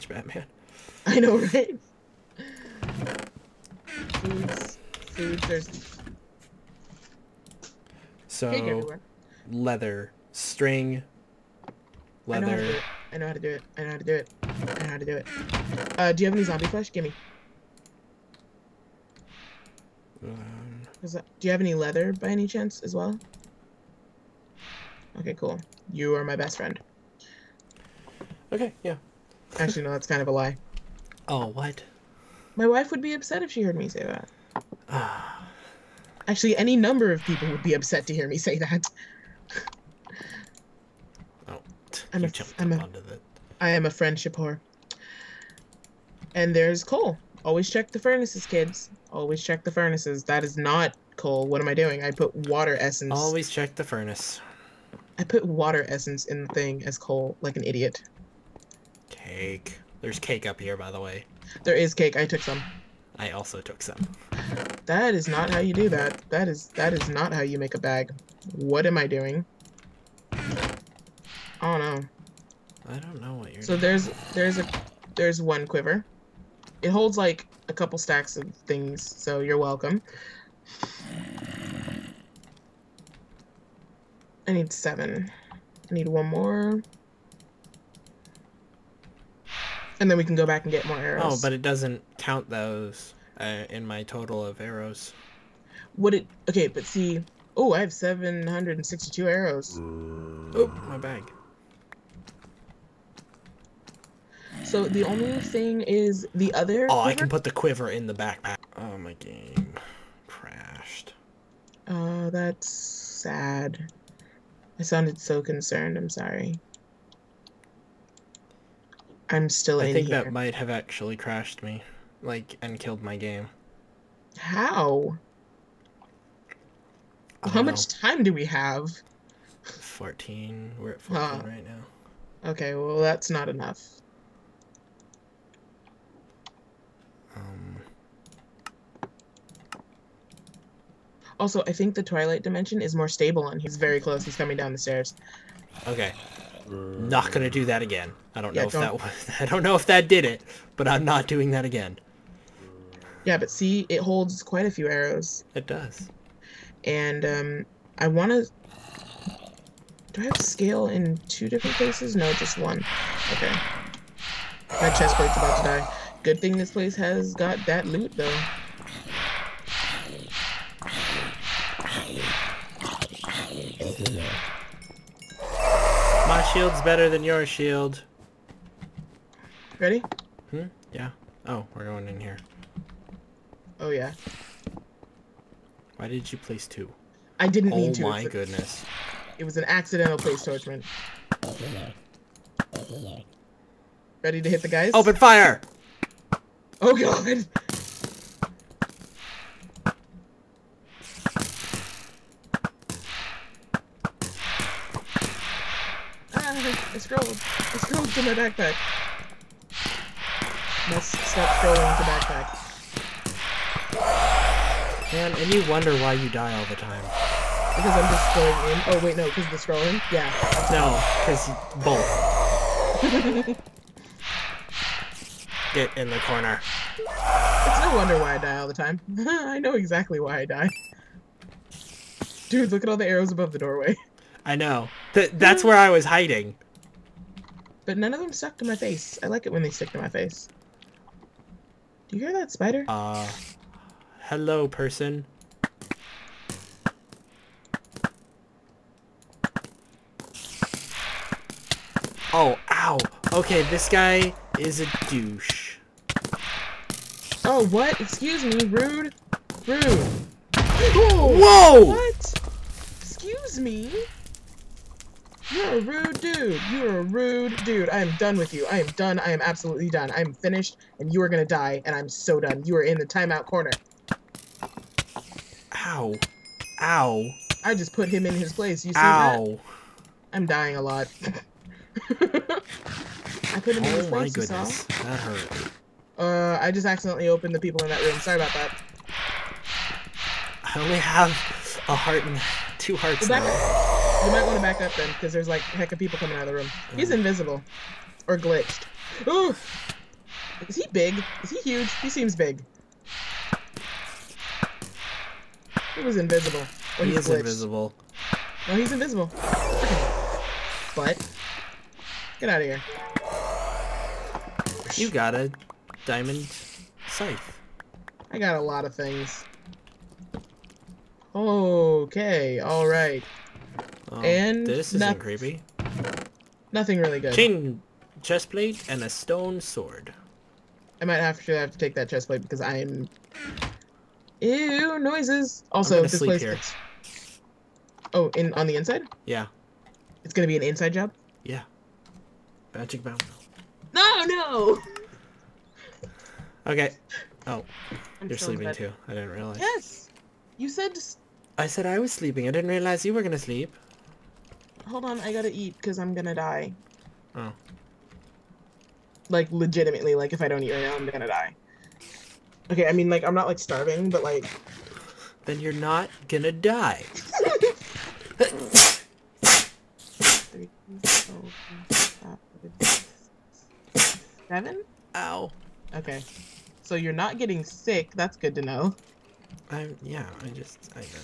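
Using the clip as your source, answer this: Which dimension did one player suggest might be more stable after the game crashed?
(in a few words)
Twilight Dimension.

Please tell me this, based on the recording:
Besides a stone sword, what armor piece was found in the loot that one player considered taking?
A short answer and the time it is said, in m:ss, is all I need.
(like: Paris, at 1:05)
Chain chestplate, at 5:27.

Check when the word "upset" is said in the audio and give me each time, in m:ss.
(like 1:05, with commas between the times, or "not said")
0:33, 0:37.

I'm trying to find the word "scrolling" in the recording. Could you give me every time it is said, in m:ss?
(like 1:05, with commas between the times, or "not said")
3:31, 3:39.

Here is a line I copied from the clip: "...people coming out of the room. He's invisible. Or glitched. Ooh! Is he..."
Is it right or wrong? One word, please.
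right.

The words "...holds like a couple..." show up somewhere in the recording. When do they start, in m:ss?
1:16.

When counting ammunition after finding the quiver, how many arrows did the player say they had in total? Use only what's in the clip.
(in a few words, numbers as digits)
762.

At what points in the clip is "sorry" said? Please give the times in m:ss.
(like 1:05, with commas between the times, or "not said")
1:56, 4:48.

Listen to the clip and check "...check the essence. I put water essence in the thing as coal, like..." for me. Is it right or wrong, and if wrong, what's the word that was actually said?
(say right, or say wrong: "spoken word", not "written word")
wrong: "furnace", not "essence".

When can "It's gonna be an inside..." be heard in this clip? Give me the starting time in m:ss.
5:40.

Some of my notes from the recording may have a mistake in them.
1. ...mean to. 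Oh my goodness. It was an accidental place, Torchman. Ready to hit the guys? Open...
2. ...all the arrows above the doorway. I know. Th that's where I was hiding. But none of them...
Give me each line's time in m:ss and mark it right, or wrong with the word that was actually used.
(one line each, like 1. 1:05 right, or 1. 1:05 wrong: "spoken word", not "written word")
1. 3:07 right
2. 3:52 right.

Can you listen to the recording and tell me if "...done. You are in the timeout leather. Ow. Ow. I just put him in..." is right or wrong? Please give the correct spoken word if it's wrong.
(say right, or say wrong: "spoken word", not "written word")
wrong: "corner", not "leather".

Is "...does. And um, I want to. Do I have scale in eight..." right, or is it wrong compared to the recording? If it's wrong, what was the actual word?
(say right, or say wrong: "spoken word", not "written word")
wrong: "two", not "eight".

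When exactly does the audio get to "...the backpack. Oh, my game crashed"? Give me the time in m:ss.
1:48.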